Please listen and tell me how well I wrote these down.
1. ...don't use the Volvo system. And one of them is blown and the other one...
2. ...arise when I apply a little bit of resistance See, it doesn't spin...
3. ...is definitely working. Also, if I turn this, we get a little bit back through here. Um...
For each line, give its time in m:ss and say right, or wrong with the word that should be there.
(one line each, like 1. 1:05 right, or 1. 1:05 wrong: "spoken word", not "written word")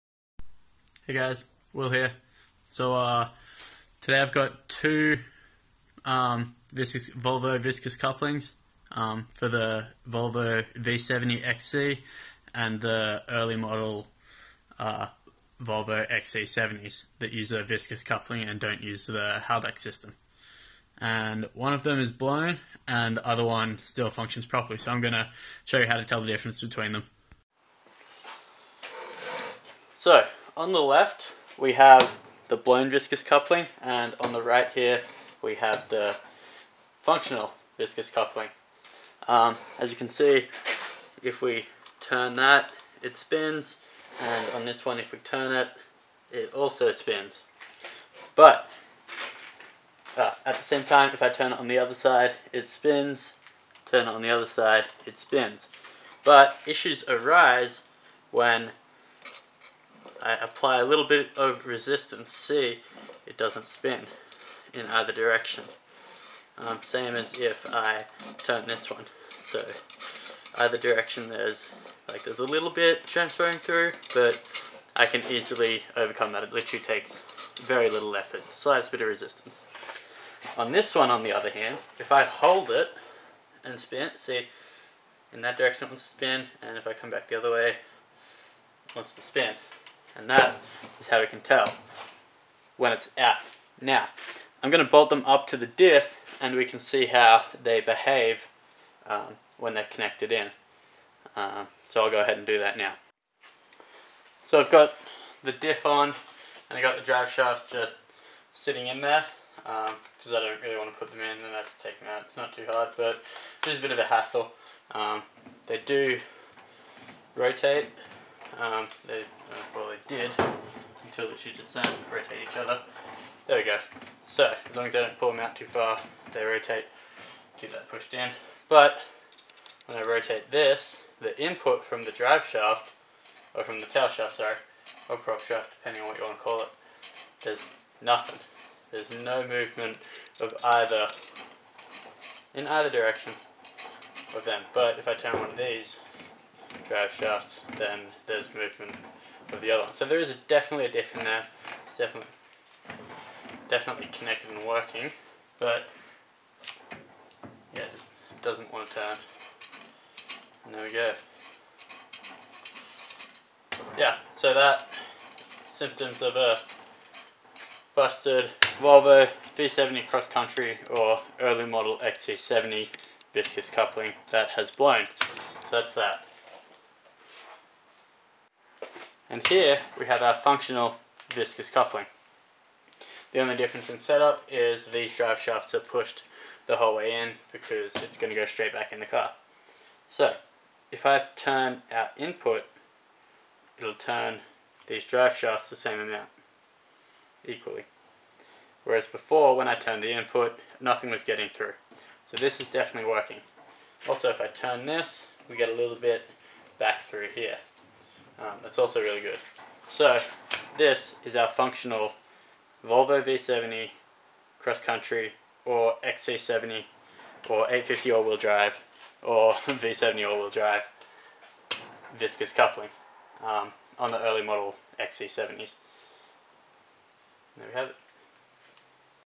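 1. 0:18 wrong: "Haldex", not "Volvo"
2. 0:57 right
3. 3:22 right.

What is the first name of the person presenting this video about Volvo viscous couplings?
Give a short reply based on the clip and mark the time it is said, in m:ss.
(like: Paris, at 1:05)
Will, at 0:01.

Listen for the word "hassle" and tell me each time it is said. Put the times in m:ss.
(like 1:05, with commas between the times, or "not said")
1:54.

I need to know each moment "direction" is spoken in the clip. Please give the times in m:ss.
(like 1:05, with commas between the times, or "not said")
1:05, 1:10, 1:25, 2:22.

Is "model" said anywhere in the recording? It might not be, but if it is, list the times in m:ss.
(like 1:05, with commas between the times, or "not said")
0:13, 2:51, 3:44.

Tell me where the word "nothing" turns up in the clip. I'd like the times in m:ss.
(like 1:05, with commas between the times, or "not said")
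2:17, 3:20.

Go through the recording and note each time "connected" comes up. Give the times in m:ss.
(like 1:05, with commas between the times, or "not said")
1:39, 2:34.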